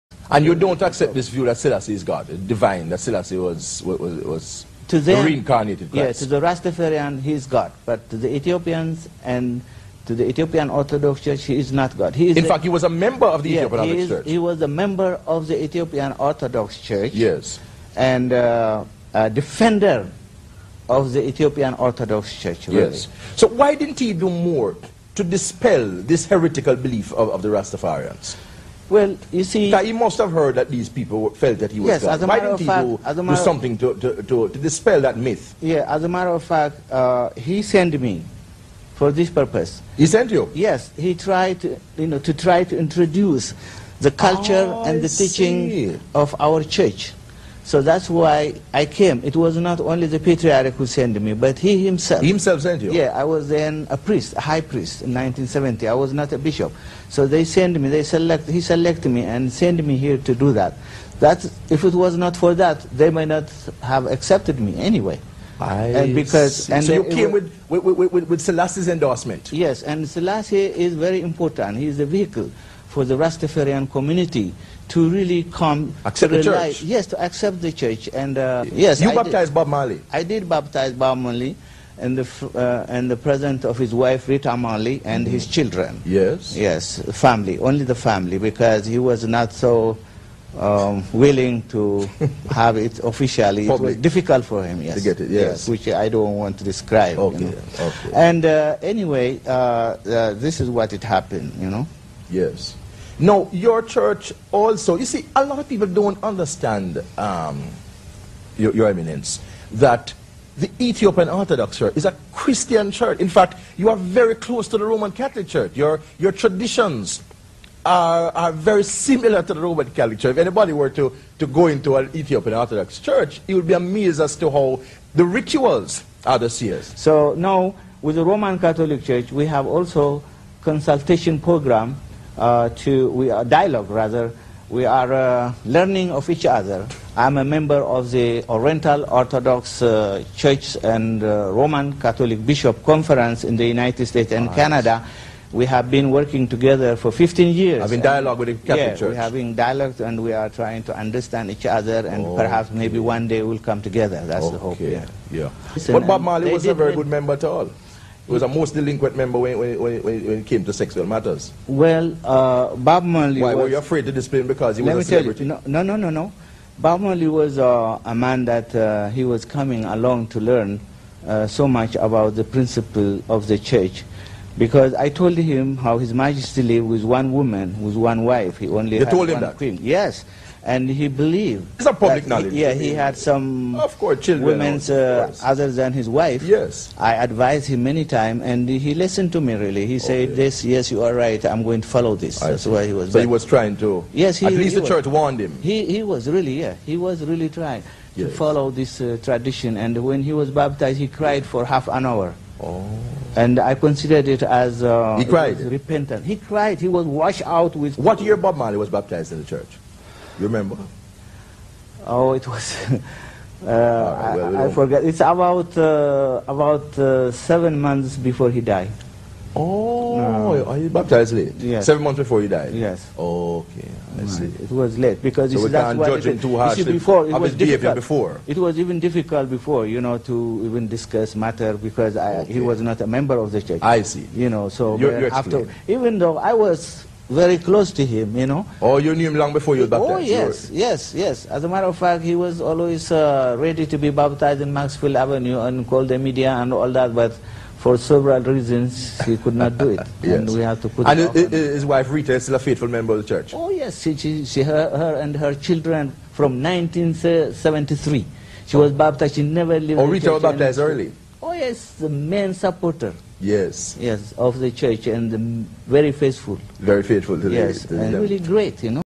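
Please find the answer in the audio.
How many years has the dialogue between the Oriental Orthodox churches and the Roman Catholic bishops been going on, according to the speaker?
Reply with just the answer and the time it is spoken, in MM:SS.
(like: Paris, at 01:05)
15 years, at 02:27.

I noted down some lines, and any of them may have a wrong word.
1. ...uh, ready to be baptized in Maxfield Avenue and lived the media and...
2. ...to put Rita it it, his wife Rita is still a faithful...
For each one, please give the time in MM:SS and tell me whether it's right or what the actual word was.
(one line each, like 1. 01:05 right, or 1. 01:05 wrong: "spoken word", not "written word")
1. 04:03 wrong: "called", not "lived"
2. 04:10 wrong: "And", not "Rita".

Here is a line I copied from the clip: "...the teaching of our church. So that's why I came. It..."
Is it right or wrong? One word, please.
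right.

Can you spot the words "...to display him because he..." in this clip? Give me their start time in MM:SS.
02:44.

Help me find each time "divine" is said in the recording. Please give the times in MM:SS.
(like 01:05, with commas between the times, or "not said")
00:02.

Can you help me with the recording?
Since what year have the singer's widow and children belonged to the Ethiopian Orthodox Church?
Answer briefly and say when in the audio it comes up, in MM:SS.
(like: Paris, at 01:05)
1973, at 04:16.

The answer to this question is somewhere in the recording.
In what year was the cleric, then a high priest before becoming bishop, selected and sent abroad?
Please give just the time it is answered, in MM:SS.
00:55.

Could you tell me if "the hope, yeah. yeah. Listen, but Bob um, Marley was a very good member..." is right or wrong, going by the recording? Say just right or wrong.
right.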